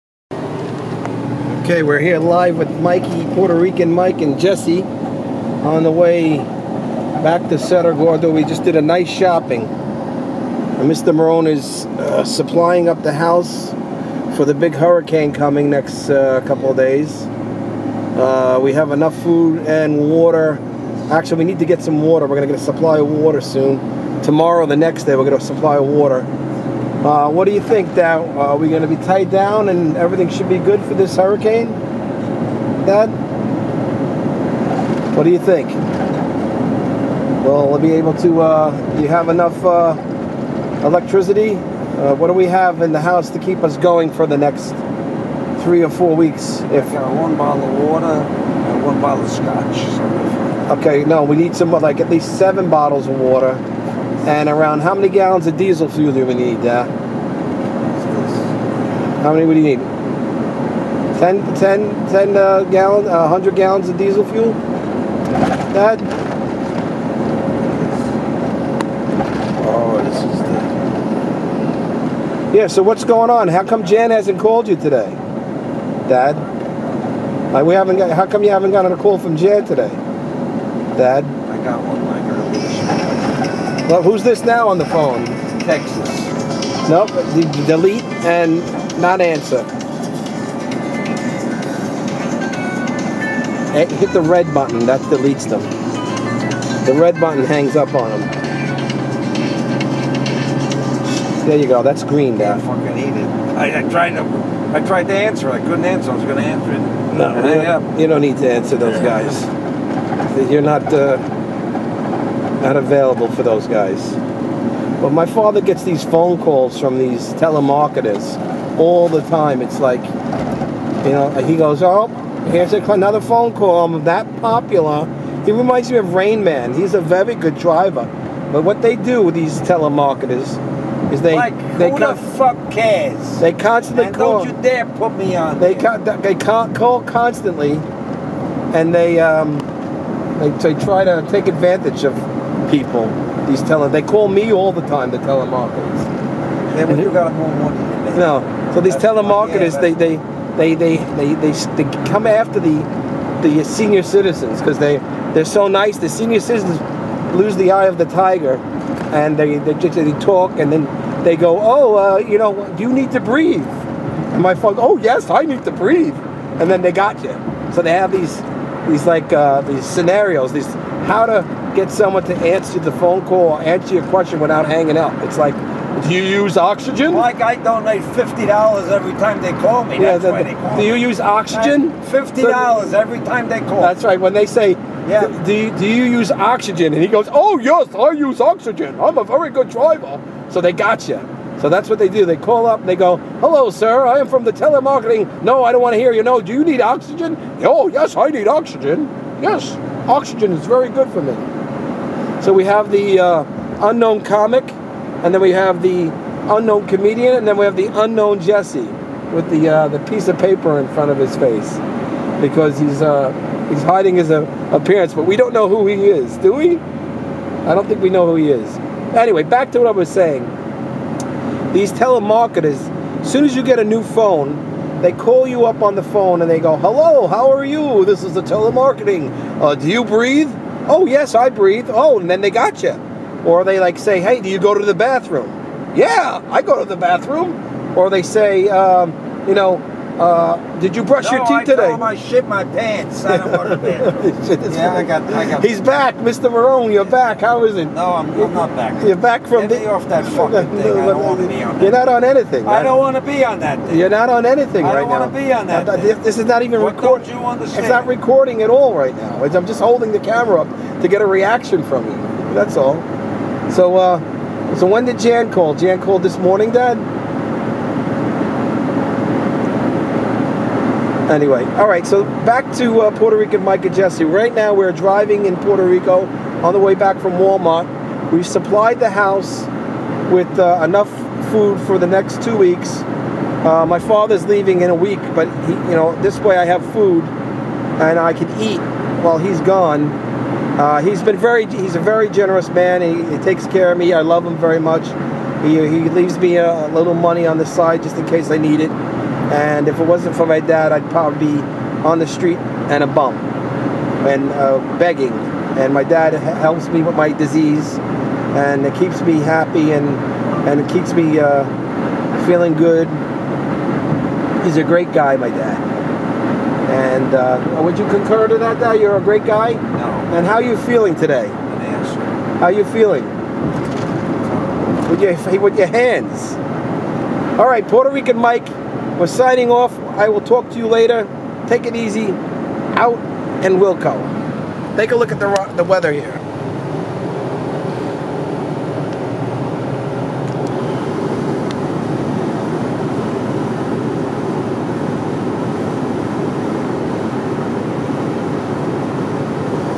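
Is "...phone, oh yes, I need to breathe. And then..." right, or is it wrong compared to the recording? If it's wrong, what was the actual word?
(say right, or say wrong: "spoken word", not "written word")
right.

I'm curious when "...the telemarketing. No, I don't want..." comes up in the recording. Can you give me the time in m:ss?
3:14.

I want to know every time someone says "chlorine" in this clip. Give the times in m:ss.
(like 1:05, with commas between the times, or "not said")
not said.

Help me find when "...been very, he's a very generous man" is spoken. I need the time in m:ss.
4:51.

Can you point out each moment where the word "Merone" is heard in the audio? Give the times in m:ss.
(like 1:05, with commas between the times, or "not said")
0:11, 4:06.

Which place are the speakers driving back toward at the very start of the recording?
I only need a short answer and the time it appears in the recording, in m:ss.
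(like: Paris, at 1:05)
Cerro Gordo, at 0:07.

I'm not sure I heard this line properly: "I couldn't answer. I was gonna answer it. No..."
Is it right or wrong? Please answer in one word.
right.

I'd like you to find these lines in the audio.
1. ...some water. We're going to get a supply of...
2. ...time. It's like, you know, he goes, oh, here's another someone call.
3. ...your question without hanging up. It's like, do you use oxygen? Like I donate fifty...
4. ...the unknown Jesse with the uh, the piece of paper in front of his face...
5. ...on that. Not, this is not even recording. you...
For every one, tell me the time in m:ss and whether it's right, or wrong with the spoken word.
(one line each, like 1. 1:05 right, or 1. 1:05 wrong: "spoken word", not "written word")
1. 0:21 right
2. 1:59 wrong: "phone", not "someone"
3. 2:53 right
4. 3:27 right
5. 4:15 right.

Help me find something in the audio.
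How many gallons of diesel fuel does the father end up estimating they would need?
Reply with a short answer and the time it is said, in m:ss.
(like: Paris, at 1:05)
100, at 1:03.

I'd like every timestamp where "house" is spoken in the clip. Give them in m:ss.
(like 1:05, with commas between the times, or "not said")
0:13, 0:43, 4:39.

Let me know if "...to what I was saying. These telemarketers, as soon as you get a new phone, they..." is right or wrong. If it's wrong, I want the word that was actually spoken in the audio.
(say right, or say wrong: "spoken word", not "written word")
right.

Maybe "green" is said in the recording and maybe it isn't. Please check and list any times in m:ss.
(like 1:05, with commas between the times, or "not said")
1:42.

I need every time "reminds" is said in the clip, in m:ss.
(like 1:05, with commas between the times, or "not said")
2:05.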